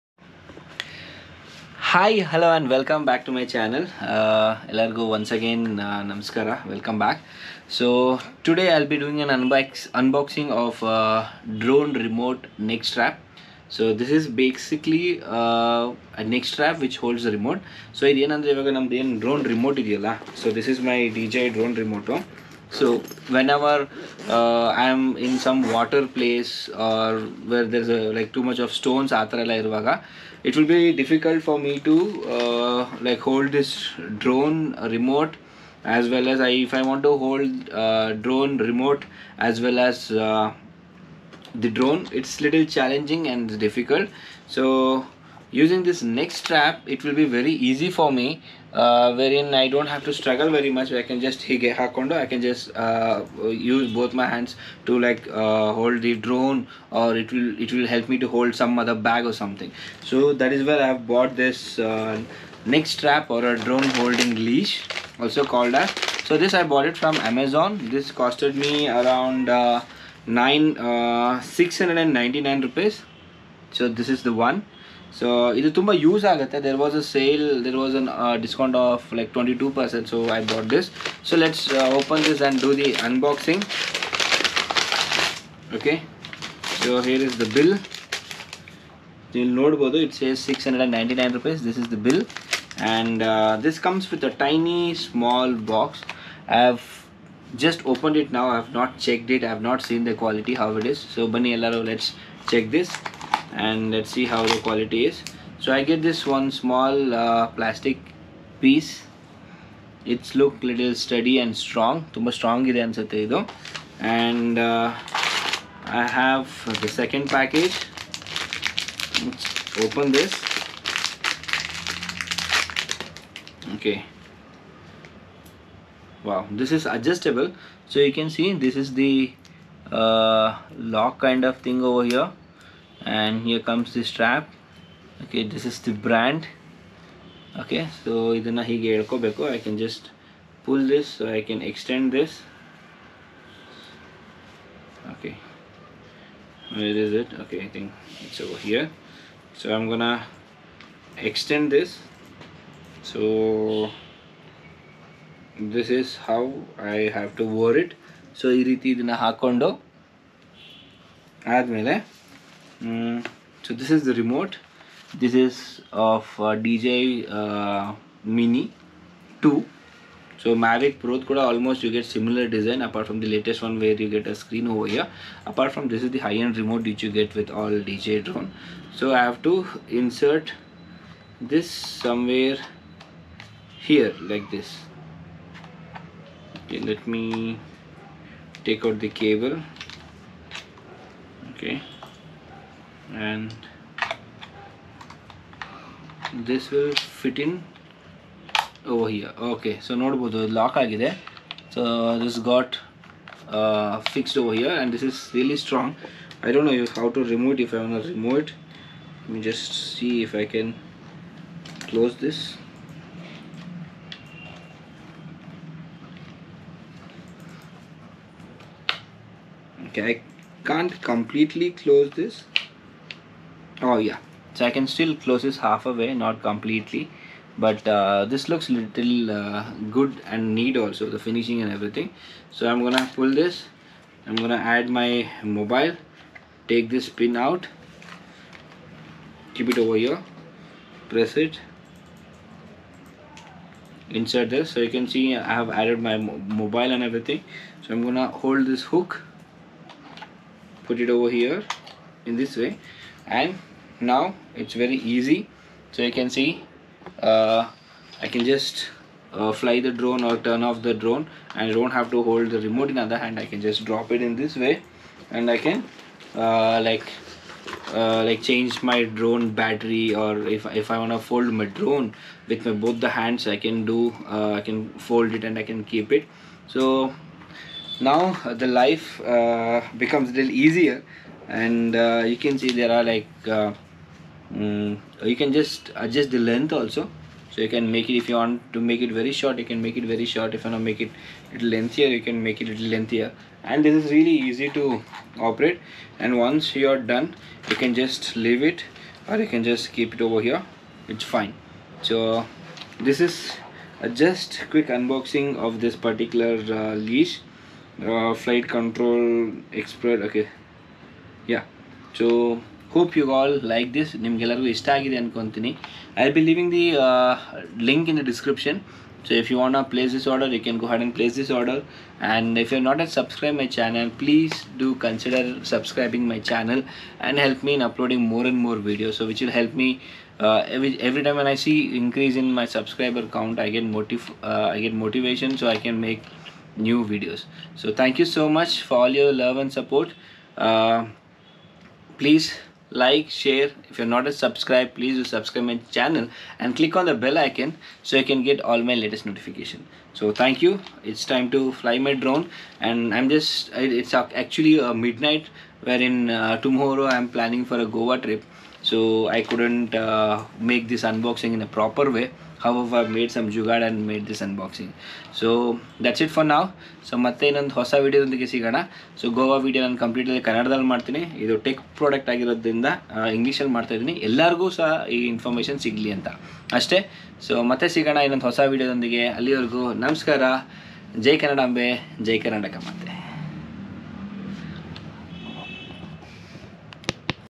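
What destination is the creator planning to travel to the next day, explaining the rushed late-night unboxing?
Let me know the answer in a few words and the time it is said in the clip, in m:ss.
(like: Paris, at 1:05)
Goa, at 5:57.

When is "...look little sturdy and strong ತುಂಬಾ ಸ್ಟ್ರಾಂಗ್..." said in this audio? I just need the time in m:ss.
1:50.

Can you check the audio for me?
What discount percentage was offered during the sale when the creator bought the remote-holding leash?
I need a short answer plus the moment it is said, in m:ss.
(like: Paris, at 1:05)
22 percent, at 1:19.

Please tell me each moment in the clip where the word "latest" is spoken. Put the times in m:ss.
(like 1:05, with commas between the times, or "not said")
2:53, 5:48.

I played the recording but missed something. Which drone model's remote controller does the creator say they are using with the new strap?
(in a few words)
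Mini 2.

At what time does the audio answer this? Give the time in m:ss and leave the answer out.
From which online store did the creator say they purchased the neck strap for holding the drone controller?
1:07.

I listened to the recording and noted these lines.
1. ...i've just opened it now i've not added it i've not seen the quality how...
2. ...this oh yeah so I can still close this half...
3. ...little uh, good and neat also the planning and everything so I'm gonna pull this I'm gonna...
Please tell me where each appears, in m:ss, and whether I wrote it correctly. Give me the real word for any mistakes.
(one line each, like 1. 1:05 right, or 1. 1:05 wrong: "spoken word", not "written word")
1. 1:36 wrong: "checked", not "added"
2. 3:42 right
3. 3:48 wrong: "finishing", not "planning".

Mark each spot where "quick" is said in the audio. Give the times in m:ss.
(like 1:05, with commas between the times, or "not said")
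5:04.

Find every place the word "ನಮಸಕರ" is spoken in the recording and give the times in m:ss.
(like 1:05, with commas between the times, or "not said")
0:06, 6:20.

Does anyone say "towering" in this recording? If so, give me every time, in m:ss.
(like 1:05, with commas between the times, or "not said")
not said.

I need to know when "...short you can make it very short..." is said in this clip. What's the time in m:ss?
4:49.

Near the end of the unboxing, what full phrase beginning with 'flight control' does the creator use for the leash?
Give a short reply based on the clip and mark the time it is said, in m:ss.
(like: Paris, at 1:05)
flight control expert, at 5:08.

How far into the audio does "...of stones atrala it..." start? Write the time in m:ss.
0:28.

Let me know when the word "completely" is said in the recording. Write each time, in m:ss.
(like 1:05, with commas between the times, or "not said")
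3:41, 3:46.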